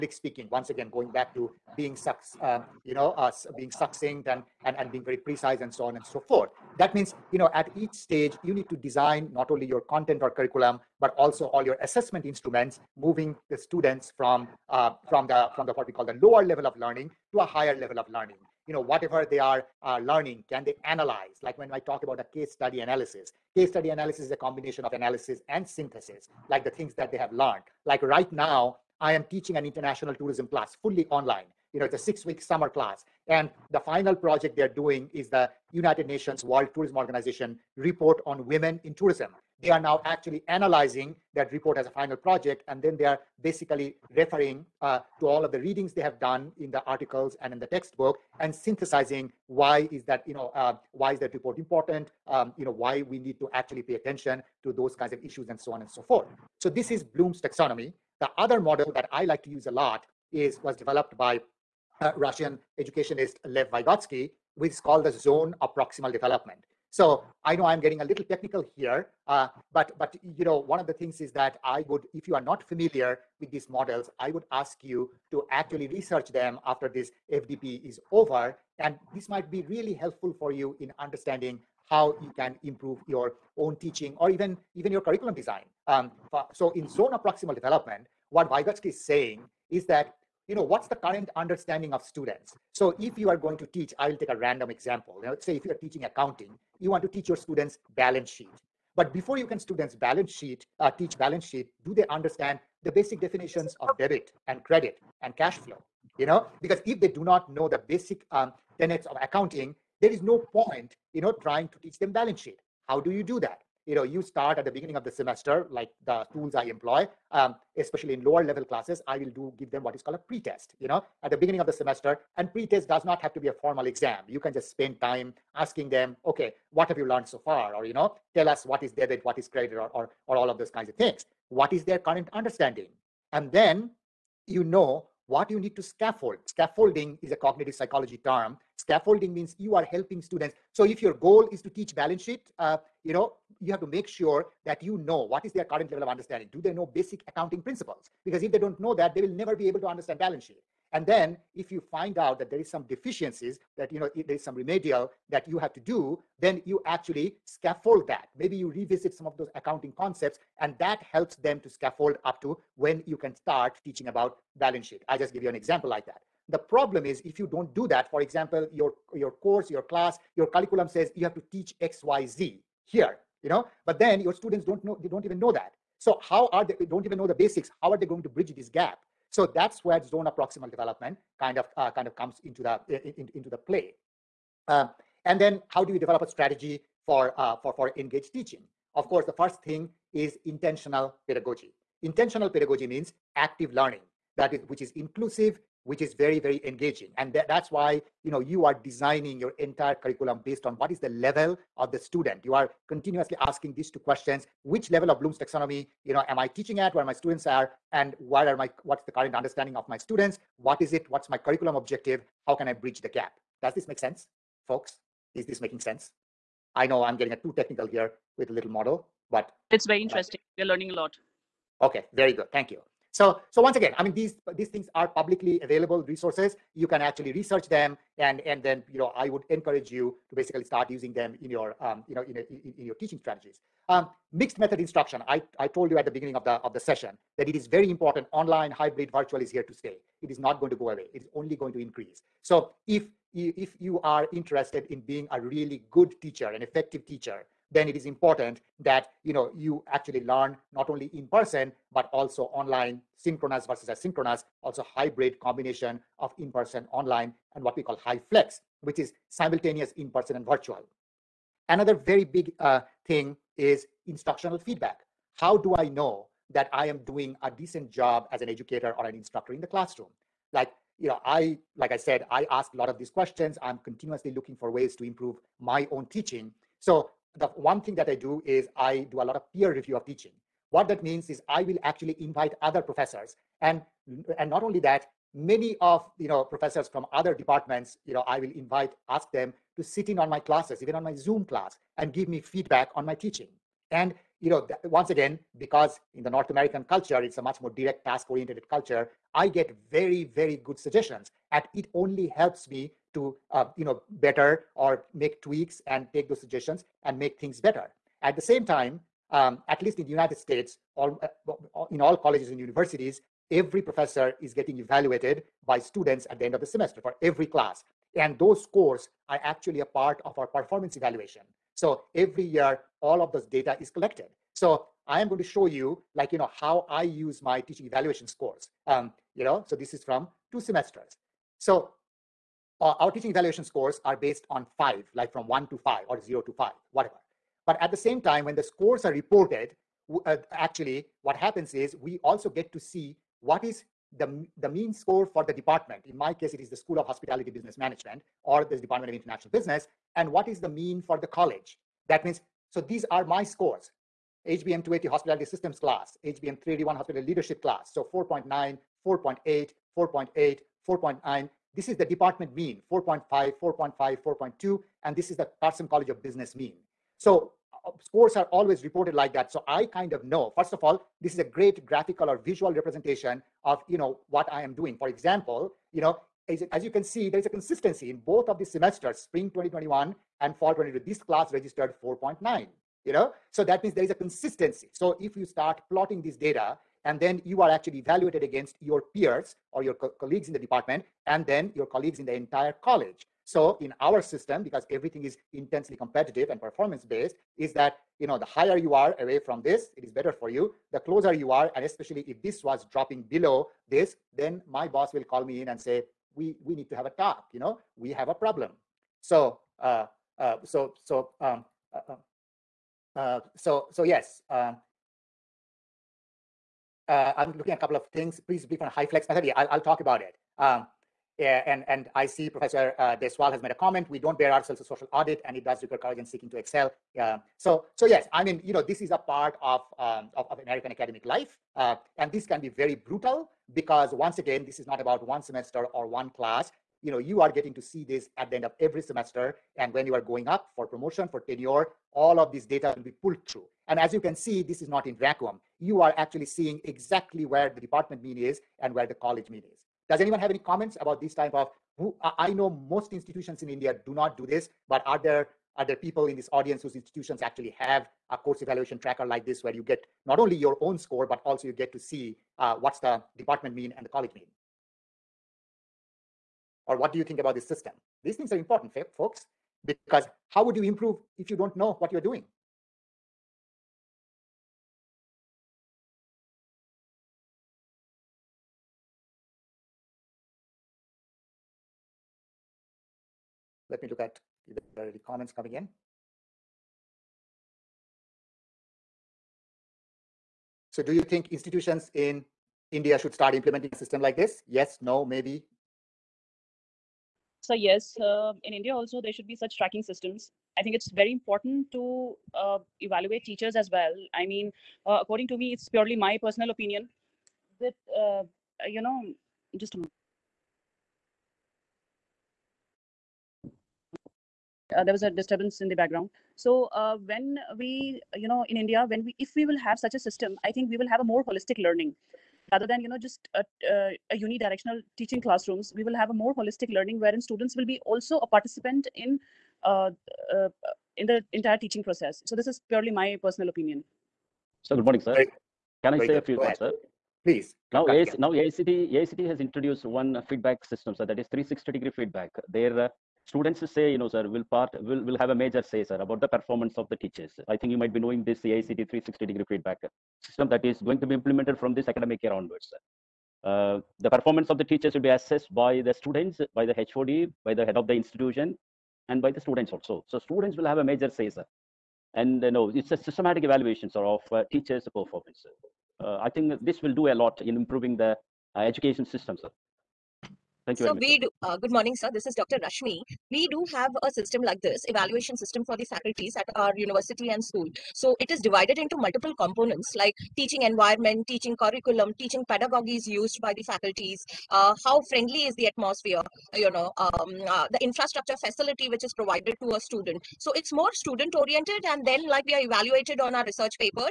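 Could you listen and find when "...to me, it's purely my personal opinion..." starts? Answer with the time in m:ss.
8:25.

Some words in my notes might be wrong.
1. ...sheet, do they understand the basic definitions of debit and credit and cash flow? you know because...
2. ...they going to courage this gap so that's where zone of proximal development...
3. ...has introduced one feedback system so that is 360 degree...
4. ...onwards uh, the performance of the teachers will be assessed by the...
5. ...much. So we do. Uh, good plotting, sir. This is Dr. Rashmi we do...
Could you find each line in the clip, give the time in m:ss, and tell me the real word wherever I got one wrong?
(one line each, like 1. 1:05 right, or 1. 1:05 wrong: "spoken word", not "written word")
1. 1:41 right
2. 2:57 wrong: "bridge", not "courage"
3. 8:59 right
4. 9:12 right
5. 9:31 wrong: "morning", not "plotting".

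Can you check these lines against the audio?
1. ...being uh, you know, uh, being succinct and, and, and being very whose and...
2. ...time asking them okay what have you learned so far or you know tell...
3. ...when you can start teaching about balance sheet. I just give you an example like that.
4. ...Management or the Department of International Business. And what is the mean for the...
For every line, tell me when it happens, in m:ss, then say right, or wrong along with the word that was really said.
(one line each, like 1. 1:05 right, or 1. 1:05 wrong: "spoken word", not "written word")
1. 0:01 wrong: "precise", not "whose"
2. 2:04 right
3. 2:42 right
4. 5:47 right.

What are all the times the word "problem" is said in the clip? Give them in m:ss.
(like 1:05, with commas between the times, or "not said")
2:46, 6:48.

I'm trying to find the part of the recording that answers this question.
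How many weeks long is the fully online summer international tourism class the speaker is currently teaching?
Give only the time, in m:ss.
0:31.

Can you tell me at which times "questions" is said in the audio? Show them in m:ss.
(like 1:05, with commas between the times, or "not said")
3:23, 4:33.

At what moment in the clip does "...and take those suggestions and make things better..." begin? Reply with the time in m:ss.
5:05.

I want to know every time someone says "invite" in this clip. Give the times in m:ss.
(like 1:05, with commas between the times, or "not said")
4:42, 4:48.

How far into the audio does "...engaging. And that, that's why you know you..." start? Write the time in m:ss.
3:16.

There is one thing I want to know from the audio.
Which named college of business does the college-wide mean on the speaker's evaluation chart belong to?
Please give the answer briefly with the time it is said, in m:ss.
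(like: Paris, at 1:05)
Carson College of Business, at 6:05.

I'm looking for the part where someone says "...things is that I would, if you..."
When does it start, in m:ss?
1:10.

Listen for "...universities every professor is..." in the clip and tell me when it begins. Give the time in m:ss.
5:12.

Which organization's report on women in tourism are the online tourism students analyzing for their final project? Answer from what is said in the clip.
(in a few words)
United Nations World Tourism Organization.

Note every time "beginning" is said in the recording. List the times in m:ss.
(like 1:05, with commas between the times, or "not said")
1:54, 2:01, 3:56.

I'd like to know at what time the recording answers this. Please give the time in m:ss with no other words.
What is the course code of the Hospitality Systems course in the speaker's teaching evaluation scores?
5:54.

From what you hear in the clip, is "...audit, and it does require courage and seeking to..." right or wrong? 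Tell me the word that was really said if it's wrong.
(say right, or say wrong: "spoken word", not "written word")
right.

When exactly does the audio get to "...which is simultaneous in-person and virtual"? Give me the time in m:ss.
4:18.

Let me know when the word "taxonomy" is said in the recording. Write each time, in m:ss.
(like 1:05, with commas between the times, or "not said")
0:57, 3:25.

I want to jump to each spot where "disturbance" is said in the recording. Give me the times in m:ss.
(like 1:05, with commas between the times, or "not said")
8:35.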